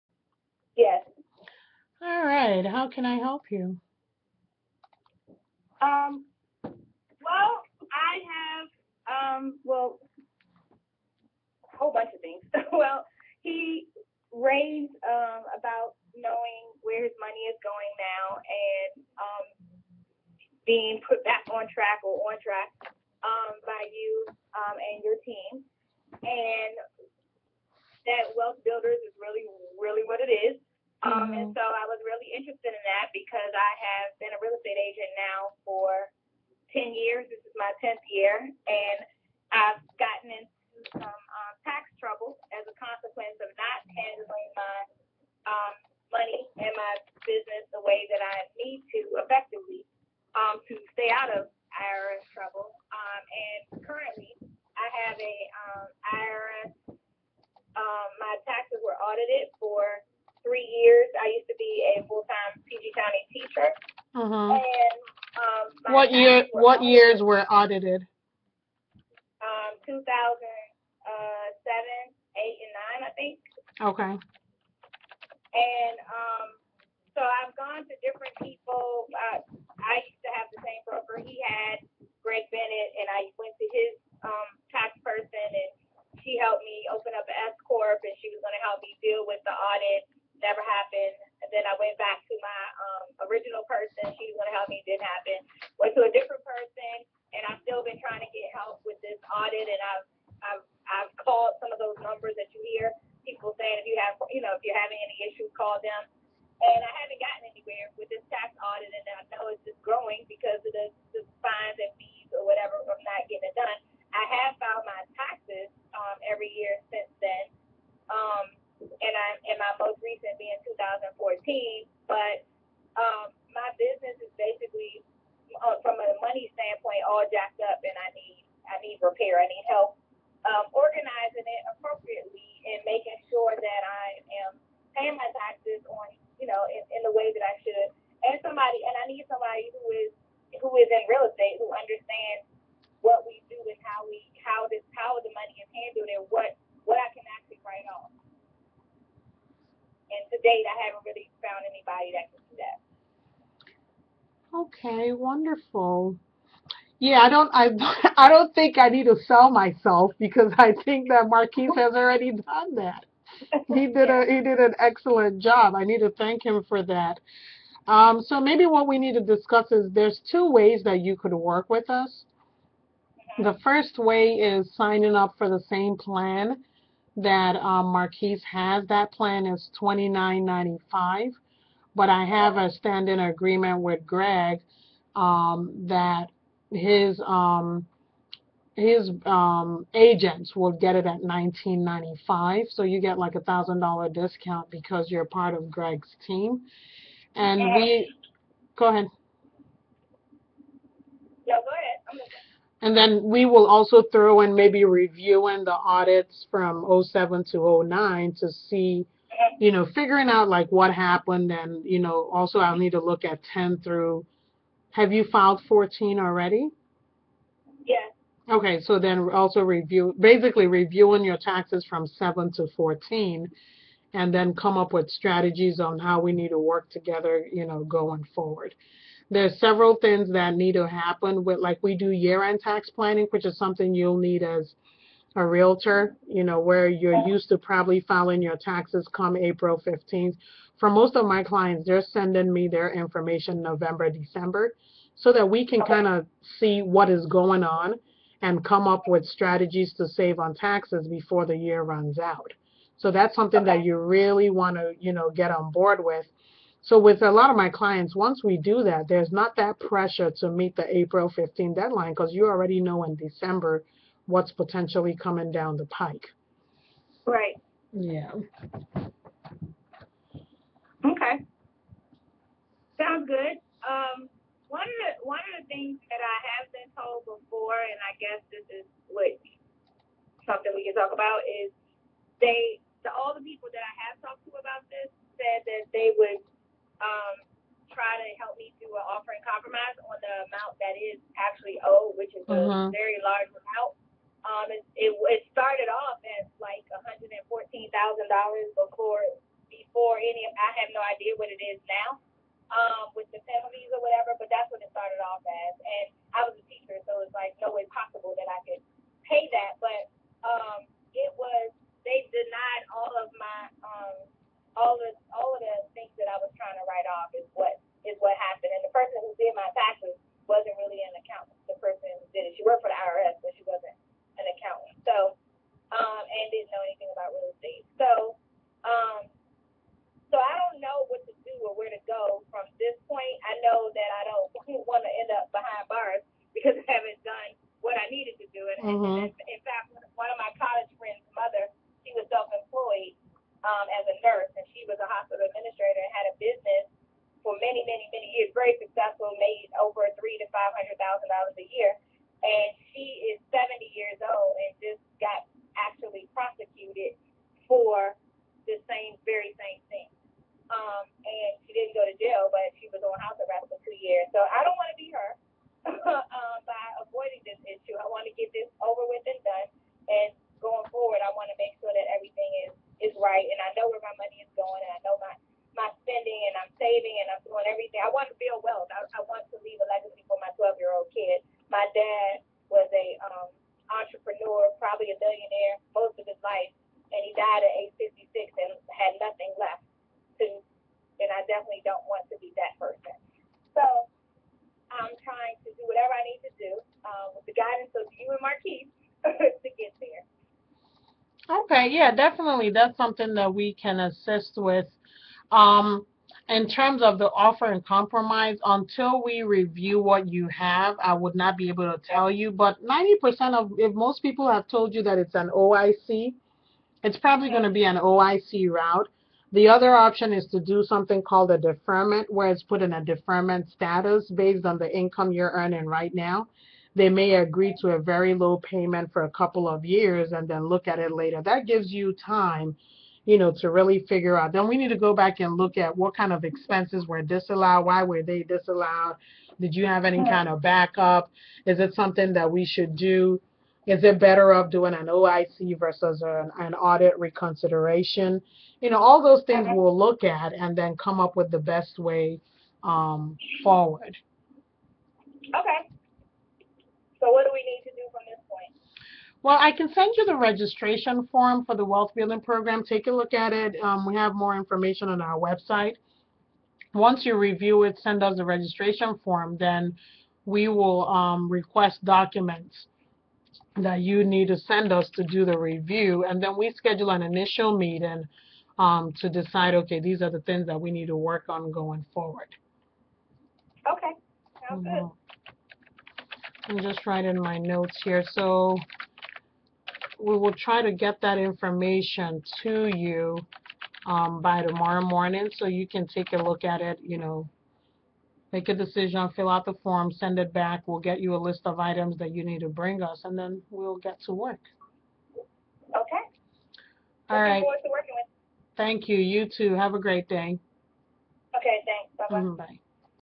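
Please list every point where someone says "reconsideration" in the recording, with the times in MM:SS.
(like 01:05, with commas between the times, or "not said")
07:27.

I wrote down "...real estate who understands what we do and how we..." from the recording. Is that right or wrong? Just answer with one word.
right.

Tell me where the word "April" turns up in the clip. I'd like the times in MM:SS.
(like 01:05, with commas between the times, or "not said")
03:59, 04:20.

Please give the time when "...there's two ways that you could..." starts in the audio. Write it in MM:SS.
02:49.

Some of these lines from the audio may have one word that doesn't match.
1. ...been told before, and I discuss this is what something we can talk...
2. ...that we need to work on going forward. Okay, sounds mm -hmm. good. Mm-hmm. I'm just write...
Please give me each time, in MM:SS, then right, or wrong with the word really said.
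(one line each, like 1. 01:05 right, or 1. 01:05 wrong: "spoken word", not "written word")
1. 04:36 wrong: "guess", not "discuss"
2. 08:00 right.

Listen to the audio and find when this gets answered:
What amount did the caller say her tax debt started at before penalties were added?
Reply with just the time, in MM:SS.
04:56.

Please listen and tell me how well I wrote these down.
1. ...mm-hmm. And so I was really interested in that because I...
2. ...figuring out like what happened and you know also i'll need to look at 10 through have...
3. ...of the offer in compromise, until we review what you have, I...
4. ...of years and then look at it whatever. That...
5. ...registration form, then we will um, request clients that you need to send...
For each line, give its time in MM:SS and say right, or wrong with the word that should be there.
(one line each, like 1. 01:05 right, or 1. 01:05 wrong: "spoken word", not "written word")
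1. 00:31 right
2. 03:29 right
3. 06:47 right
4. 07:09 wrong: "later", not "whatever"
5. 07:48 wrong: "documents", not "clients".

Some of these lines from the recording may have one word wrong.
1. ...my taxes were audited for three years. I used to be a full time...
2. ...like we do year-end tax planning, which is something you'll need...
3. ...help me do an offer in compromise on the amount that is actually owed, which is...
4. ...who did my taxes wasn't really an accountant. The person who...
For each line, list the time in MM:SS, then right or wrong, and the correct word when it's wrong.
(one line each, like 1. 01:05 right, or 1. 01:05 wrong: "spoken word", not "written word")
1. 00:58 right
2. 03:51 right
3. 04:48 right
4. 05:19 right.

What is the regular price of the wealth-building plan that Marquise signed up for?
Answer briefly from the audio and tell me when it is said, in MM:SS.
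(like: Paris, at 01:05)
29.95, at 02:59.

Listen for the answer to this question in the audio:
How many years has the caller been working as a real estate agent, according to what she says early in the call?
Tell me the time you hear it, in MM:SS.
00:36.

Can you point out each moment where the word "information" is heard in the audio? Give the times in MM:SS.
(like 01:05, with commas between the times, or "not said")
04:02, 07:44, 08:11.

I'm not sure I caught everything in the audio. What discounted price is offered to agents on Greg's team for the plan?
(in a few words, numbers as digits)
19.95.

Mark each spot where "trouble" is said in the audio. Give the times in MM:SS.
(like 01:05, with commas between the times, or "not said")
00:41, 00:52.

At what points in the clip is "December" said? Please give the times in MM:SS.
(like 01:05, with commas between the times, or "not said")
04:04, 04:23.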